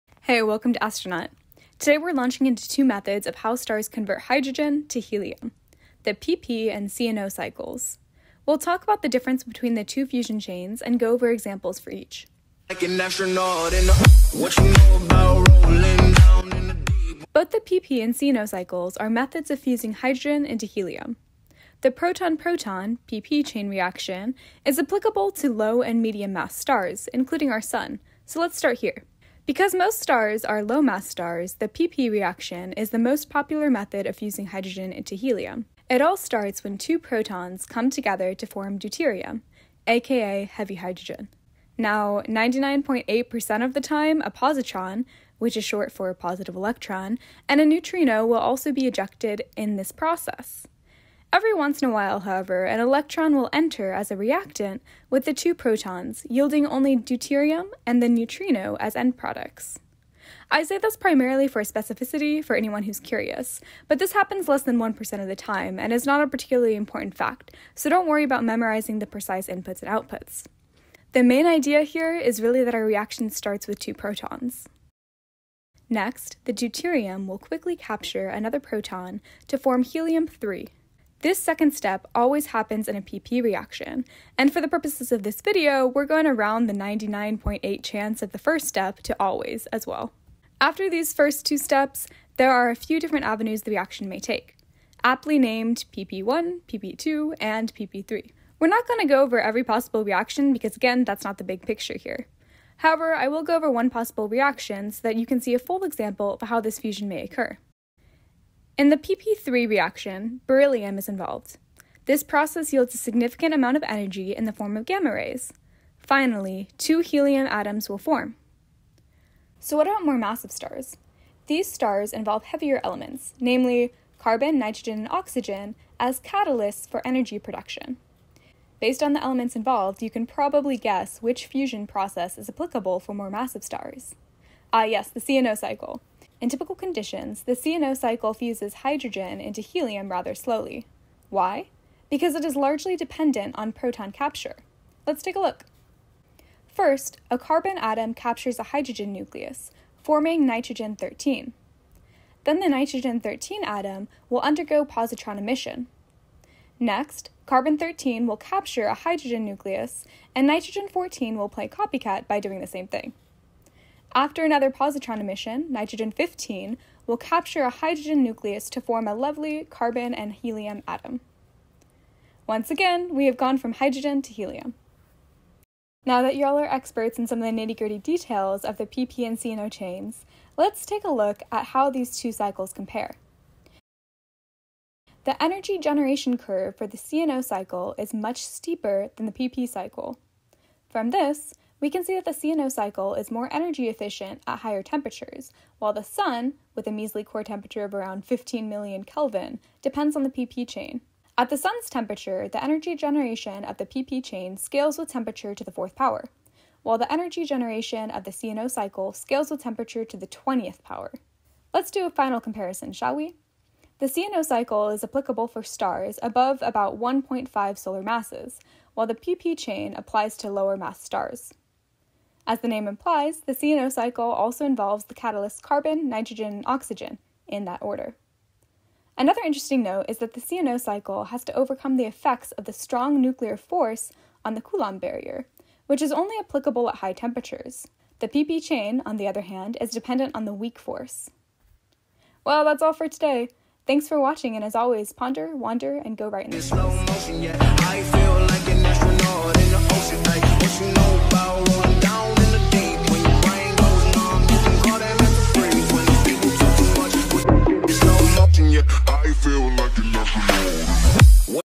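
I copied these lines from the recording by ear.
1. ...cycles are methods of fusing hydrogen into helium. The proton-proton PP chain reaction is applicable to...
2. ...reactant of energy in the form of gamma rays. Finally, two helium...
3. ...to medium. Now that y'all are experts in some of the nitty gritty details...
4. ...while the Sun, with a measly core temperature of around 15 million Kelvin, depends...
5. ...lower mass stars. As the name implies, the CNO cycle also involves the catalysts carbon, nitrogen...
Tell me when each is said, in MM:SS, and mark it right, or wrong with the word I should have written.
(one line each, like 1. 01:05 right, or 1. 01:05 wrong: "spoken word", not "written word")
1. 00:18 right
2. 01:53 wrong: "amount", not "reactant"
3. 02:54 wrong: "helium", not "medium"
4. 03:15 right
5. 03:40 right.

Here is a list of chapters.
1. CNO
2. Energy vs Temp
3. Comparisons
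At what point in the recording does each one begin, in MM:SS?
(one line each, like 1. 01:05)
1. 01:59
2. 02:55
3. 03:31.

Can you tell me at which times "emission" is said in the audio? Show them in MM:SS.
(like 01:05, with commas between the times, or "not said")
02:35, 02:45.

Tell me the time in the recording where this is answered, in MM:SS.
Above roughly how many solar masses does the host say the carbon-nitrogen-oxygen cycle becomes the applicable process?
03:36.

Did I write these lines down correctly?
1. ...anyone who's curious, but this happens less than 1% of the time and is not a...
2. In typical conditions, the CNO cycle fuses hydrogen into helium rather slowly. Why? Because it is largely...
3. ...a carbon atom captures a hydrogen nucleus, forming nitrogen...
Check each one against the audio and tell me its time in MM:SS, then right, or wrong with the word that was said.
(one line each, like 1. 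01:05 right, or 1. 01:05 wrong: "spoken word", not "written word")
1. 01:02 right
2. 02:16 right
3. 02:27 right.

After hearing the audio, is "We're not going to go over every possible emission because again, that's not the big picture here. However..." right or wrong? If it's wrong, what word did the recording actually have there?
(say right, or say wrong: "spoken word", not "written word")
wrong: "reaction", not "emission".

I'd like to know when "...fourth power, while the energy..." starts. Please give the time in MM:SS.
03:25.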